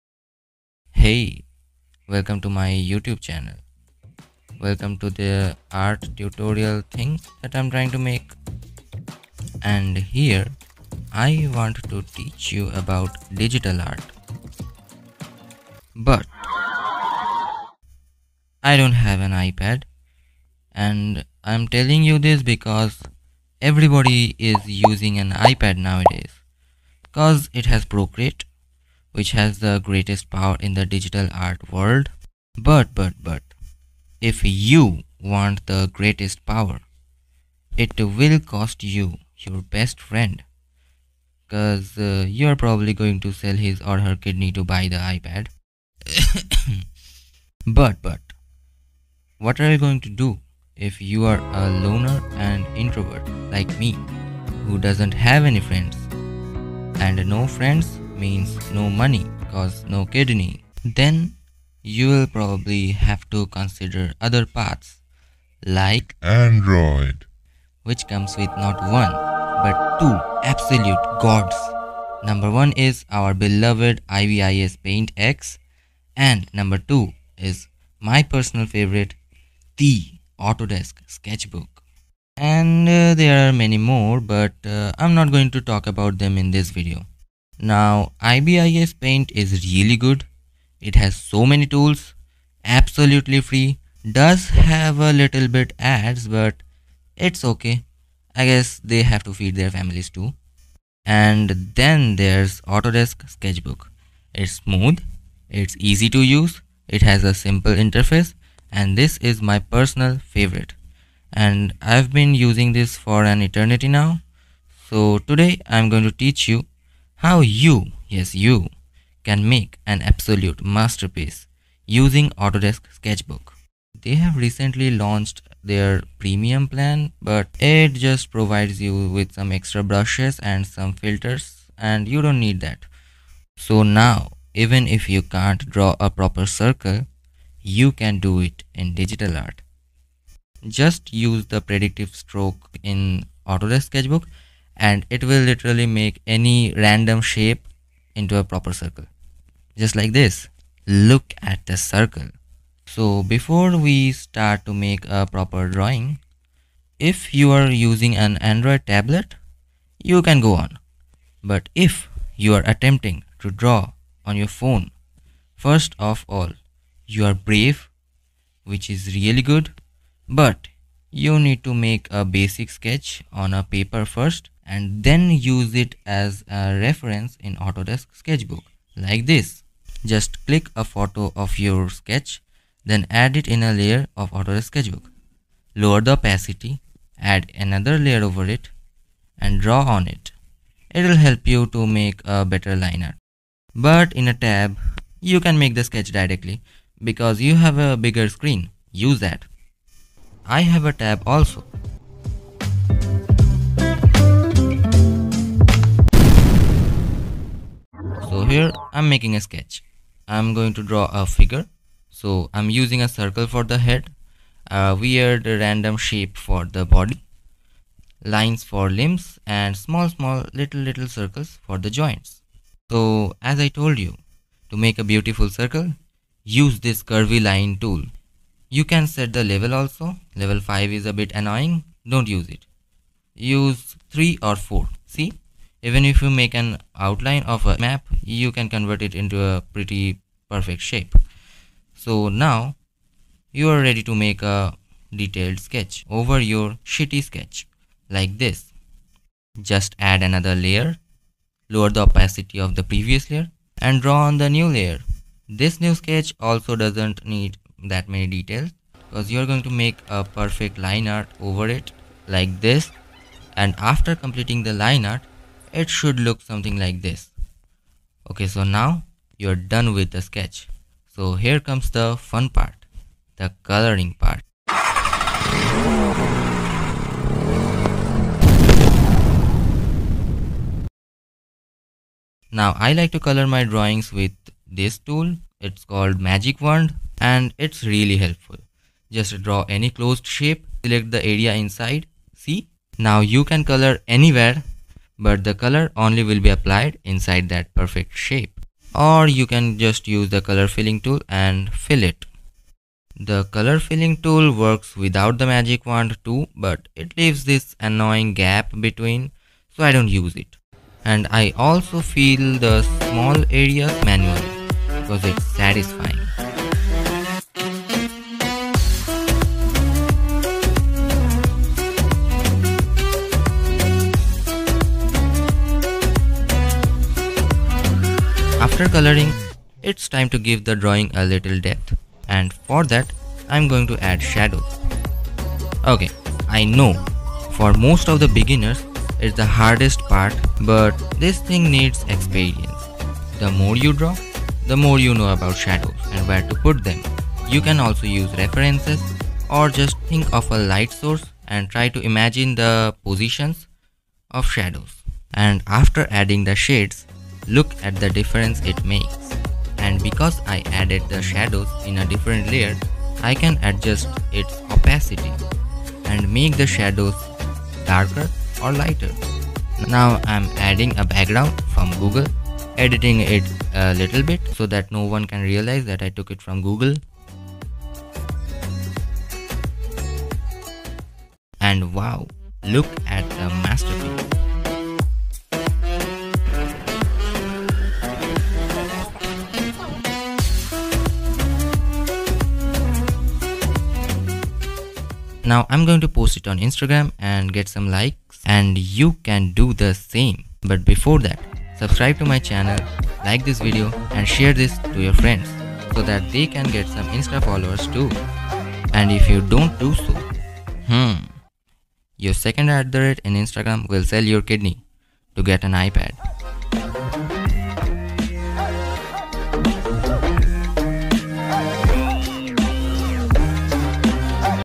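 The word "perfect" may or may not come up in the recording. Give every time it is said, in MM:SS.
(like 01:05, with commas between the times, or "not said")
04:00, 04:20, 04:57.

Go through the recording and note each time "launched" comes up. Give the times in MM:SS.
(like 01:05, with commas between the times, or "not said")
02:04.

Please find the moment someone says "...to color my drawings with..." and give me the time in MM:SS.
04:43.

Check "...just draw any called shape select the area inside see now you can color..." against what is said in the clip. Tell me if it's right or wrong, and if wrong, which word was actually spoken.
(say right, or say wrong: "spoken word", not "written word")
wrong: "closed", not "called".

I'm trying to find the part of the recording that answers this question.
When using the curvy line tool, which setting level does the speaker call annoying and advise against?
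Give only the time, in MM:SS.
03:50.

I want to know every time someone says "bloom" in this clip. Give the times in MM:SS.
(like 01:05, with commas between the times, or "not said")
not said.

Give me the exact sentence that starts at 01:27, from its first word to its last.
Now IBIS Paint is really good.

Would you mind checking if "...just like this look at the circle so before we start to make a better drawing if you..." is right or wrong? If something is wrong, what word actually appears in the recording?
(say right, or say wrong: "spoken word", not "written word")
wrong: "proper", not "better".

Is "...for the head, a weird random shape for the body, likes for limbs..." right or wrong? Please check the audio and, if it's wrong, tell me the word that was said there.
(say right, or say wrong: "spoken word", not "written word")
wrong: "lines", not "likes".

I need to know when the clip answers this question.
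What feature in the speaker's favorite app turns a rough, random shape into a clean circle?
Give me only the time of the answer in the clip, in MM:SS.
02:21.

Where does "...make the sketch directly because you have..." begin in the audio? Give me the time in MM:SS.
03:15.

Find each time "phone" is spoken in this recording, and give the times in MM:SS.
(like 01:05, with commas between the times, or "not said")
02:44.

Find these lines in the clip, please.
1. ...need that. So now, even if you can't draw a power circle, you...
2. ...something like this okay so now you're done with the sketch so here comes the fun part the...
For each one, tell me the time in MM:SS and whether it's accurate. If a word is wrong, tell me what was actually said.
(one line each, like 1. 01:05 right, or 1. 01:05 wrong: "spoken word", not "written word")
1. 02:12 wrong: "proper", not "power"
2. 04:26 right.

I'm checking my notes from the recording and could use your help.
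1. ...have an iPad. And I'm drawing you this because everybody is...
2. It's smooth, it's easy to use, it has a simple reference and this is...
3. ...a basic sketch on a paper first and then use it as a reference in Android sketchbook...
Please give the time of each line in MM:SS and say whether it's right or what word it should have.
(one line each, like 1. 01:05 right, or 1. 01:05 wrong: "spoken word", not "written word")
1. 00:19 wrong: "telling", not "drawing"
2. 01:44 wrong: "interface", not "reference"
3. 02:52 wrong: "Autodesk", not "Android".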